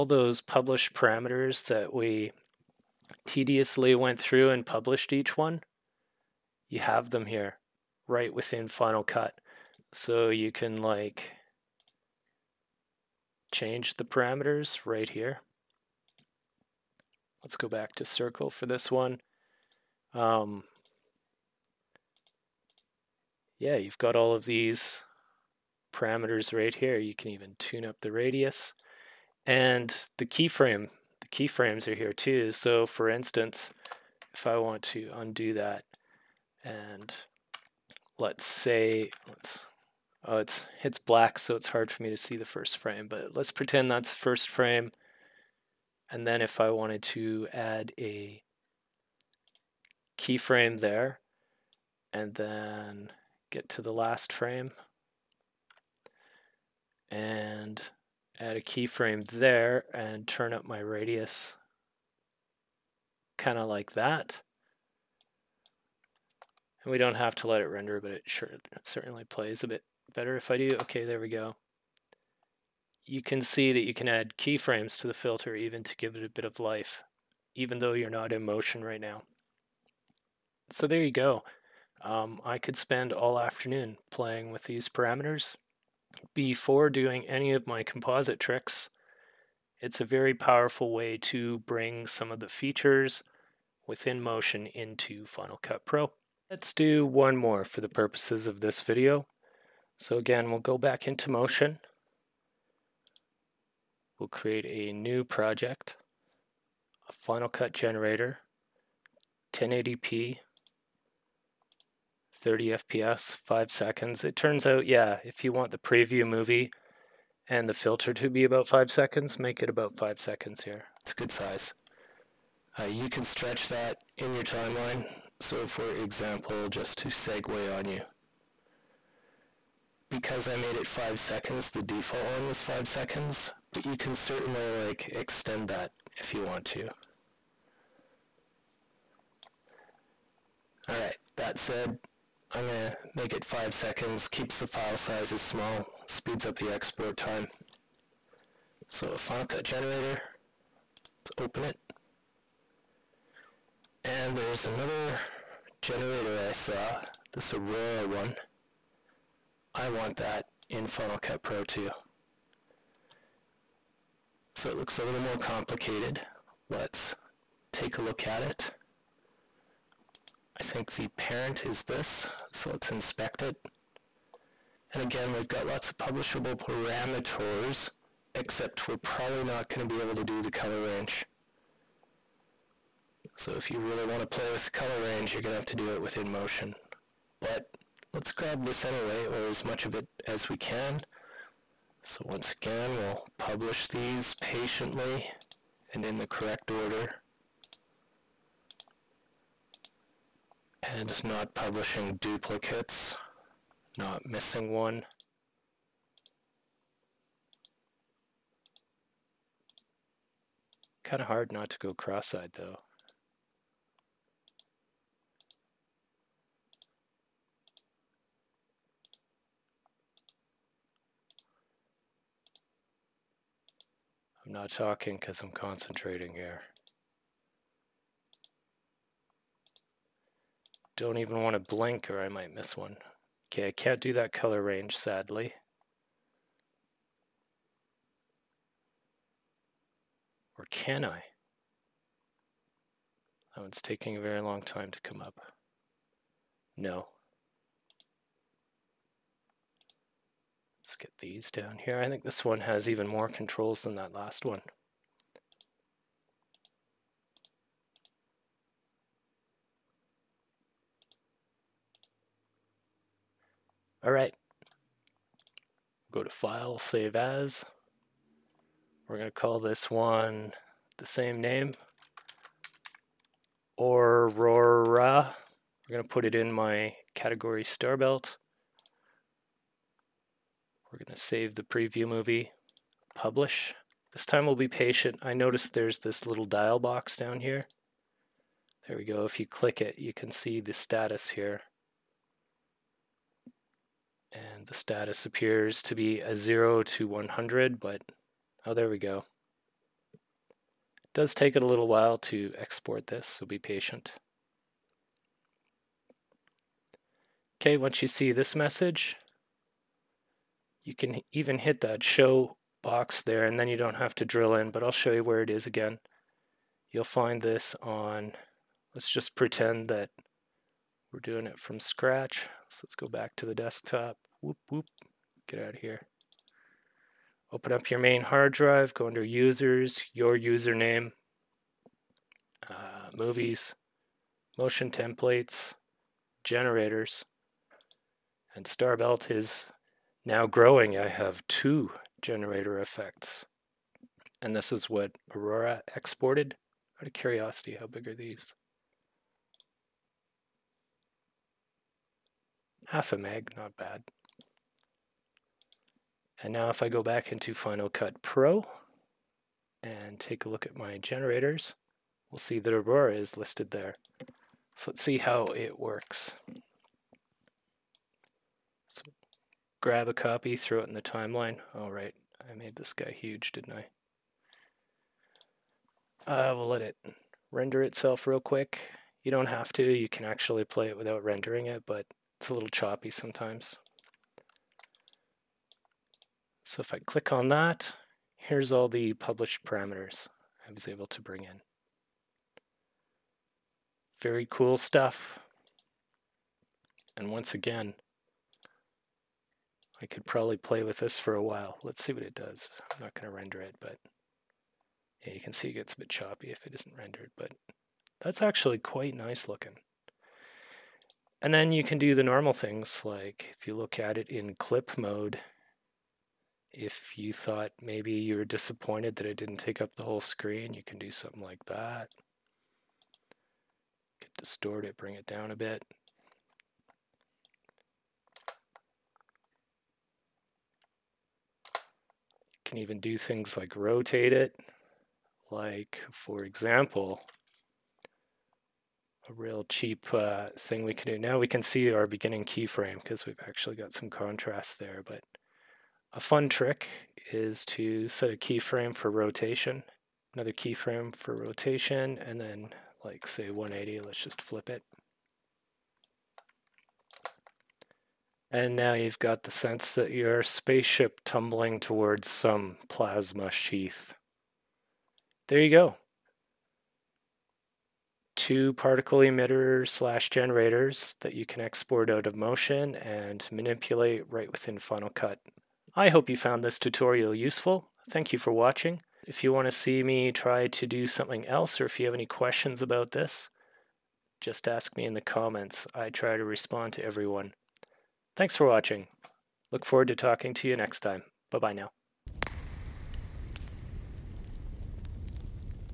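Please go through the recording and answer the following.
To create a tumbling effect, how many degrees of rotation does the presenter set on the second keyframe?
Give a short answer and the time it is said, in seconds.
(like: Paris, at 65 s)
180, at 453 s.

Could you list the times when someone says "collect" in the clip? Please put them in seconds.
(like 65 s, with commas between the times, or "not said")
not said.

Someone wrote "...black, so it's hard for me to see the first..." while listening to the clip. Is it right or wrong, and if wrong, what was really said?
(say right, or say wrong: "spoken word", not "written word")
right.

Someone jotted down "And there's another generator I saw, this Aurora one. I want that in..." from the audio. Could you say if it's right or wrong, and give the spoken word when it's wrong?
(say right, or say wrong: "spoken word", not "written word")
right.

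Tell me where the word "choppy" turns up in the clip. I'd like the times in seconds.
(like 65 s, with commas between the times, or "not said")
382 s, 406 s.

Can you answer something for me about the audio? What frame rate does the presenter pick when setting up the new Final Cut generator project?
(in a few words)
30 FPS.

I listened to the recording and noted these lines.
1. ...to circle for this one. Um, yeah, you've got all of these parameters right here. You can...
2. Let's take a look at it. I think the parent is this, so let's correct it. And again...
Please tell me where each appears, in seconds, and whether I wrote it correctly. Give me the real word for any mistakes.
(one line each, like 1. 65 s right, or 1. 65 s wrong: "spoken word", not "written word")
1. 17 s right
2. 166 s wrong: "inspect", not "correct".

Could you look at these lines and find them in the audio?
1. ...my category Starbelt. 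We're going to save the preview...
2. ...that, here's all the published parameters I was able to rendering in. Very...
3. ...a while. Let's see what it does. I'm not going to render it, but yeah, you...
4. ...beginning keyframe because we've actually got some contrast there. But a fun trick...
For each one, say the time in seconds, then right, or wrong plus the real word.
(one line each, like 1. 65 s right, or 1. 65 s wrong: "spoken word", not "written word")
1. 276 s right
2. 387 s wrong: "bring", not "rendering"
3. 401 s right
4. 442 s right.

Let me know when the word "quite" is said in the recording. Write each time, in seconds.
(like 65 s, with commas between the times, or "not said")
408 s.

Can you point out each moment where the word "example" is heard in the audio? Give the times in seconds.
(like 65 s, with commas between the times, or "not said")
125 s, 436 s.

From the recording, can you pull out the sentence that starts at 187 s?
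But let's grab this anyway, or as much of it as we can.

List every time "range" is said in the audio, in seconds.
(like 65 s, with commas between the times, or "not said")
180 s, 185 s, 234 s.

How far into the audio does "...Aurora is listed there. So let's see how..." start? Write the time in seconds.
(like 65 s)
362 s.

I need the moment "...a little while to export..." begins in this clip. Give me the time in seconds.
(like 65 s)
301 s.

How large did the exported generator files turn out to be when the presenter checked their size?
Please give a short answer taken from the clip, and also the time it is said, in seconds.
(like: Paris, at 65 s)
half a meg, at 352 s.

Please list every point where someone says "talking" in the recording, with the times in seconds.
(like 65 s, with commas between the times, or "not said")
224 s, 490 s.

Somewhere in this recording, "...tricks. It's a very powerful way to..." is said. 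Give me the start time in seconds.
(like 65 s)
88 s.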